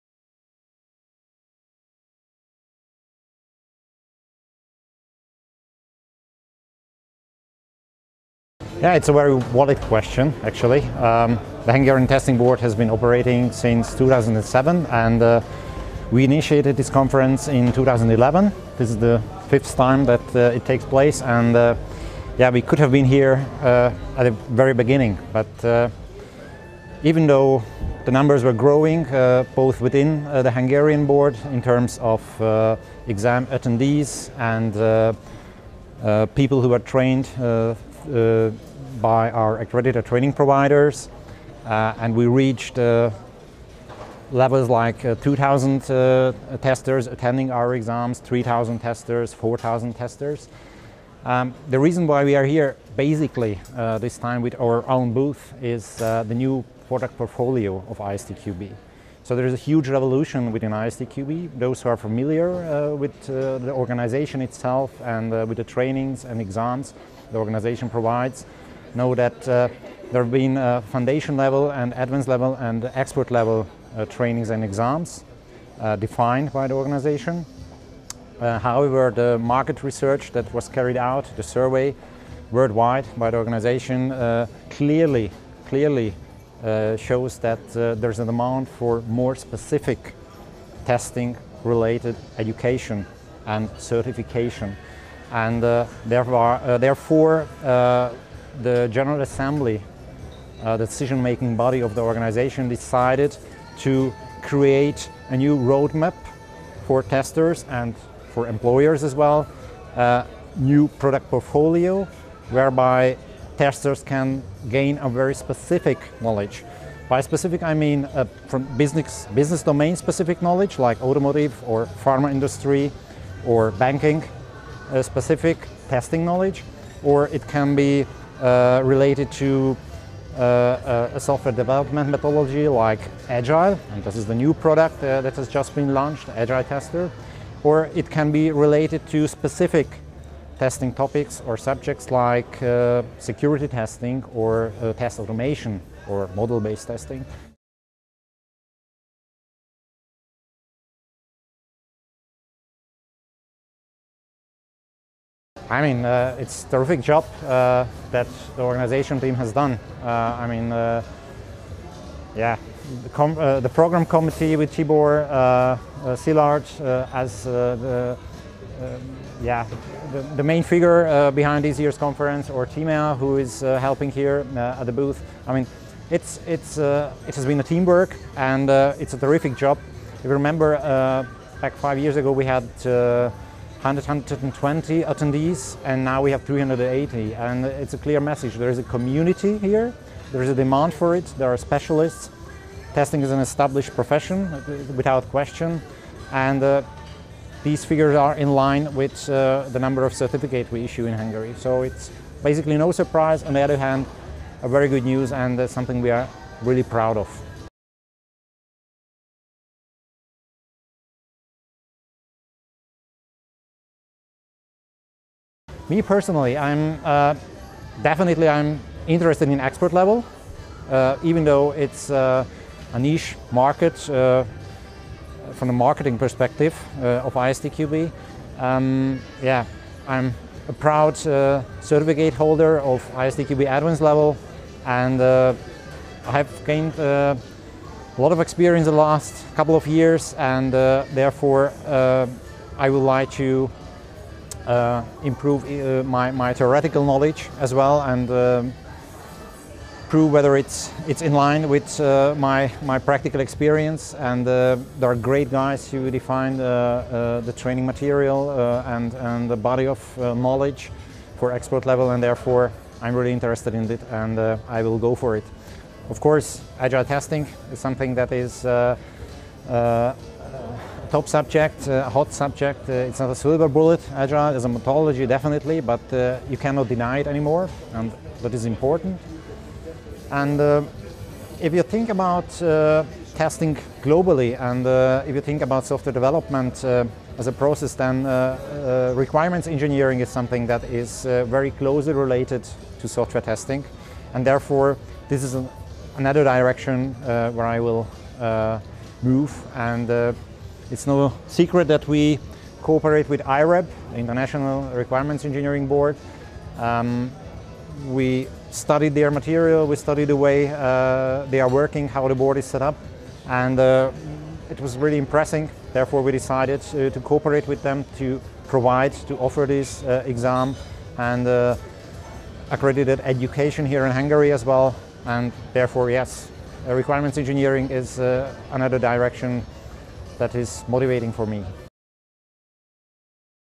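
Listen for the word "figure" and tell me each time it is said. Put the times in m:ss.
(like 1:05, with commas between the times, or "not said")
2:50, 3:17.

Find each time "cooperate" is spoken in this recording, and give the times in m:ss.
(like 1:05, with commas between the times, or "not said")
5:02, 5:17.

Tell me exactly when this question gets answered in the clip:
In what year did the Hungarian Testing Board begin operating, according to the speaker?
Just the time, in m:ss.
0:13.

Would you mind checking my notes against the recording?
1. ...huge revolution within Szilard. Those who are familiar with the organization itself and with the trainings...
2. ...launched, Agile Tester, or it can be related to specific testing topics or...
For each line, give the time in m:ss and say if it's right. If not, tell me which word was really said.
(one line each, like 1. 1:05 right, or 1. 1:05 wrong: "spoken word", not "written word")
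1. 0:59 wrong: "ISTQB", not "Szilard"
2. 2:15 right.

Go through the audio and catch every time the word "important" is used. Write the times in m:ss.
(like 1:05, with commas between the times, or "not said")
4:38.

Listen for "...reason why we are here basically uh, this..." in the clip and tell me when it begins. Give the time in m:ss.
0:51.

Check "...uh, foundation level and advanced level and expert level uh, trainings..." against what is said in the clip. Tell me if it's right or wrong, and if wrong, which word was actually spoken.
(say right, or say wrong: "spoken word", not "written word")
right.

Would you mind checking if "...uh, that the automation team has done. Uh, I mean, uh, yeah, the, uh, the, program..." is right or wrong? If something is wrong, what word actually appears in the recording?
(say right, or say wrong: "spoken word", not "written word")
wrong: "organization", not "automation".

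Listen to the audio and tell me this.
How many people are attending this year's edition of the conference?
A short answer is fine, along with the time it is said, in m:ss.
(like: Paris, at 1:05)
380, at 3:06.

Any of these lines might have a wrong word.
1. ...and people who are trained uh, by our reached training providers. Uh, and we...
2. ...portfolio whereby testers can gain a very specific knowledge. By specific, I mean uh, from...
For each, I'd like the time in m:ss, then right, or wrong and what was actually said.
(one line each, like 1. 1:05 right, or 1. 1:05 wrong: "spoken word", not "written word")
1. 0:34 wrong: "accredited", not "reached"
2. 1:51 right.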